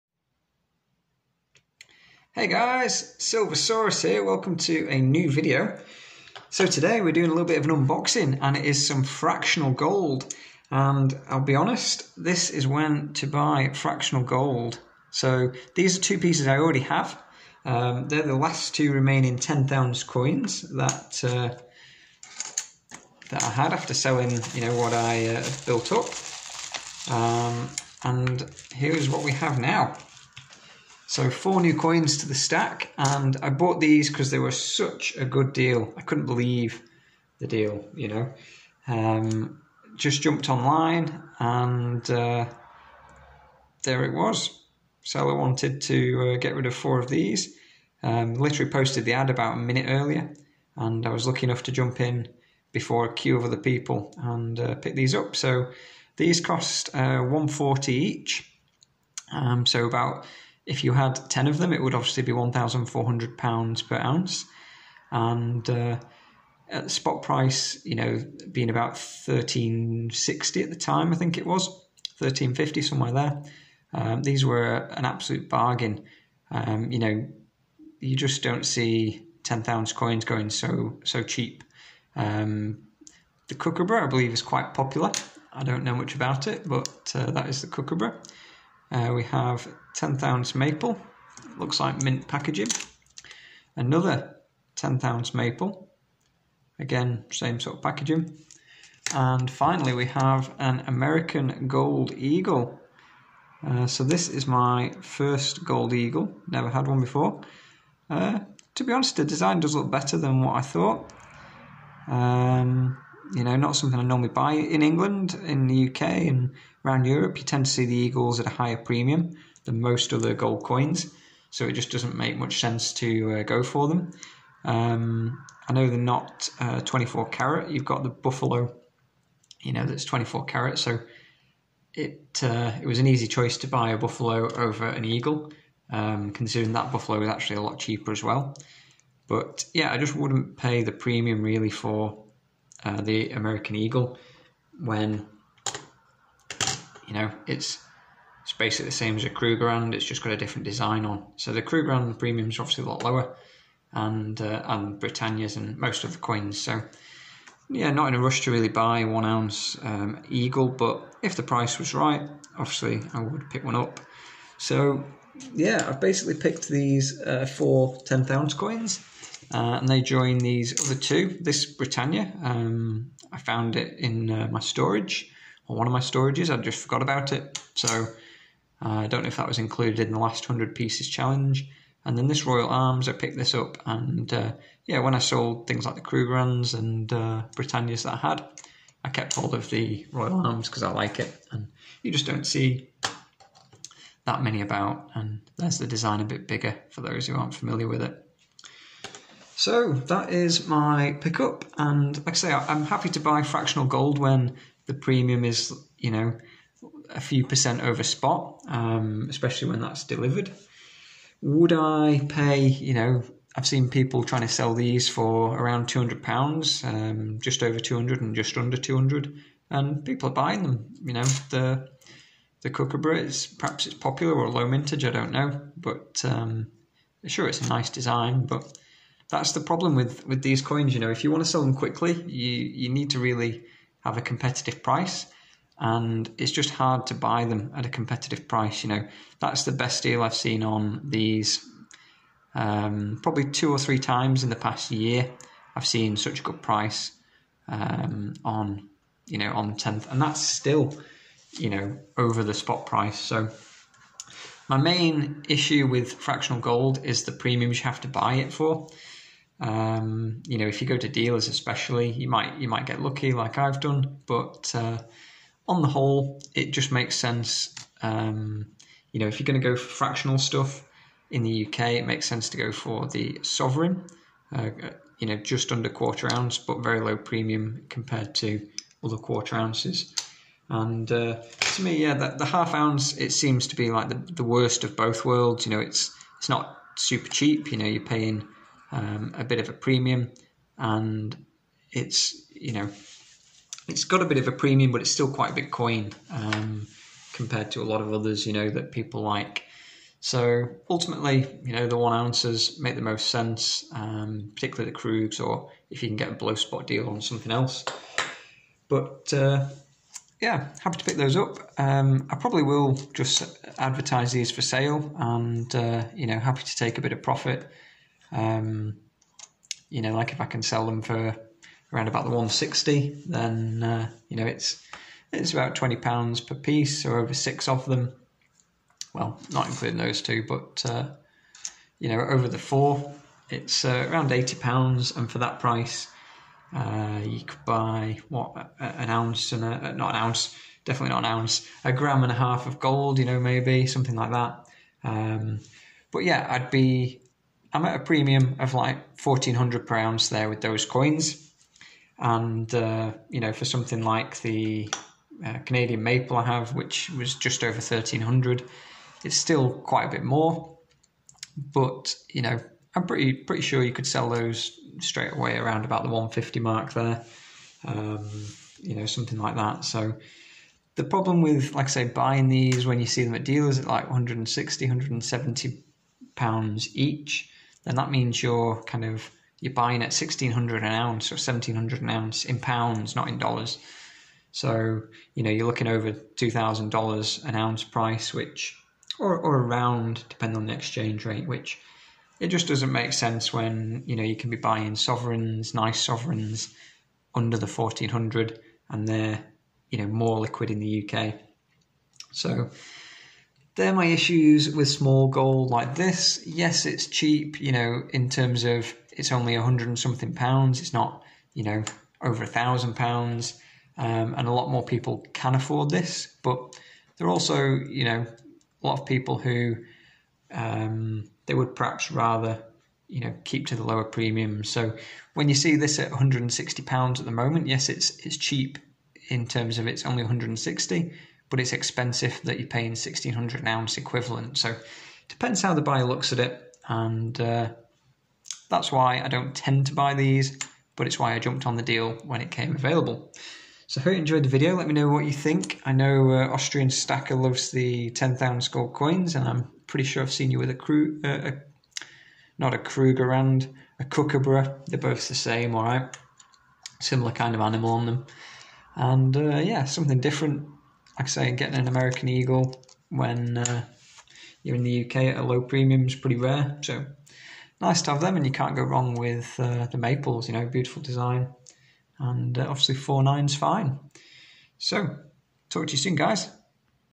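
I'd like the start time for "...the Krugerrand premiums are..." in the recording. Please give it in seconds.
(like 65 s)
151 s.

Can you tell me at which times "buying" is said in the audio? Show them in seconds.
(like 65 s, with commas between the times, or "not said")
220 s, 372 s, 379 s, 394 s.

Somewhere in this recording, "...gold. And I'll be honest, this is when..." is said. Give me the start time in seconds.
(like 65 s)
9 s.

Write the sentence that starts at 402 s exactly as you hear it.
So they're my issues with small gold like this.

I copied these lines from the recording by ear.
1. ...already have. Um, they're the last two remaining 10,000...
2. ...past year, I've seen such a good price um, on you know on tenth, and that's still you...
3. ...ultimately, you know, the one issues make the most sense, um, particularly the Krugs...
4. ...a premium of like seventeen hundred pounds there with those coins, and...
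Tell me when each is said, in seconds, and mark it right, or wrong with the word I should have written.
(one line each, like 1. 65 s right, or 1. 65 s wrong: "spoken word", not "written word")
1. 16 s right
2. 244 s right
3. 300 s wrong: "ounces", not "issues"
4. 347 s wrong: "fourteen", not "seventeen".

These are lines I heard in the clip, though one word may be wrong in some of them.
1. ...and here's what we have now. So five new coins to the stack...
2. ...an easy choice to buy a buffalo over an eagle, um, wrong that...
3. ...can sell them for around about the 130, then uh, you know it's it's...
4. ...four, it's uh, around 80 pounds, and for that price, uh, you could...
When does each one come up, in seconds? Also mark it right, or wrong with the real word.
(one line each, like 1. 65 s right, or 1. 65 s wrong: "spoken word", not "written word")
1. 28 s wrong: "four", not "five"
2. 132 s wrong: "considering", not "wrong"
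3. 320 s wrong: "160", not "130"
4. 332 s right.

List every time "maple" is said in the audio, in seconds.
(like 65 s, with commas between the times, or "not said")
90 s, 95 s, 356 s, 469 s.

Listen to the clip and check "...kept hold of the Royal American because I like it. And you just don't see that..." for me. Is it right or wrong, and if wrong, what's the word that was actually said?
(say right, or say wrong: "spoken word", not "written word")
wrong: "Arms", not "American".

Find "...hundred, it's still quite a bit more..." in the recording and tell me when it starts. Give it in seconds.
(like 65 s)
358 s.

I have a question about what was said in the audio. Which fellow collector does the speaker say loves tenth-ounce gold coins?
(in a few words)
Austrian Stacker.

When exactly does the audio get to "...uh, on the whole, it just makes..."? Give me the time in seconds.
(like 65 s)
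264 s.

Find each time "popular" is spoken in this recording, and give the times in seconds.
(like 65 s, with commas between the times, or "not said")
84 s, 223 s.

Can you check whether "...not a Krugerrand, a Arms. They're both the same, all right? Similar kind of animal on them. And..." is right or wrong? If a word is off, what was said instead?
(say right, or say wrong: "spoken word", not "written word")
wrong: "Kookaburra", not "Arms".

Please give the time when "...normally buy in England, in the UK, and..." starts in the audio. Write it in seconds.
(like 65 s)
114 s.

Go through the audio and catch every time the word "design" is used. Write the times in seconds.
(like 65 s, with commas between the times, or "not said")
109 s, 150 s, 195 s, 227 s, 471 s.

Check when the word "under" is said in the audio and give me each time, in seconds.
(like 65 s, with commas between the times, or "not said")
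218 s, 275 s, 397 s.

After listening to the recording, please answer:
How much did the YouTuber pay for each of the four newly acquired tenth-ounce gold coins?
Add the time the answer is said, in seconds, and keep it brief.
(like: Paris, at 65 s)
£140, at 57 s.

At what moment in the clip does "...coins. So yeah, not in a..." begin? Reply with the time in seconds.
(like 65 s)
156 s.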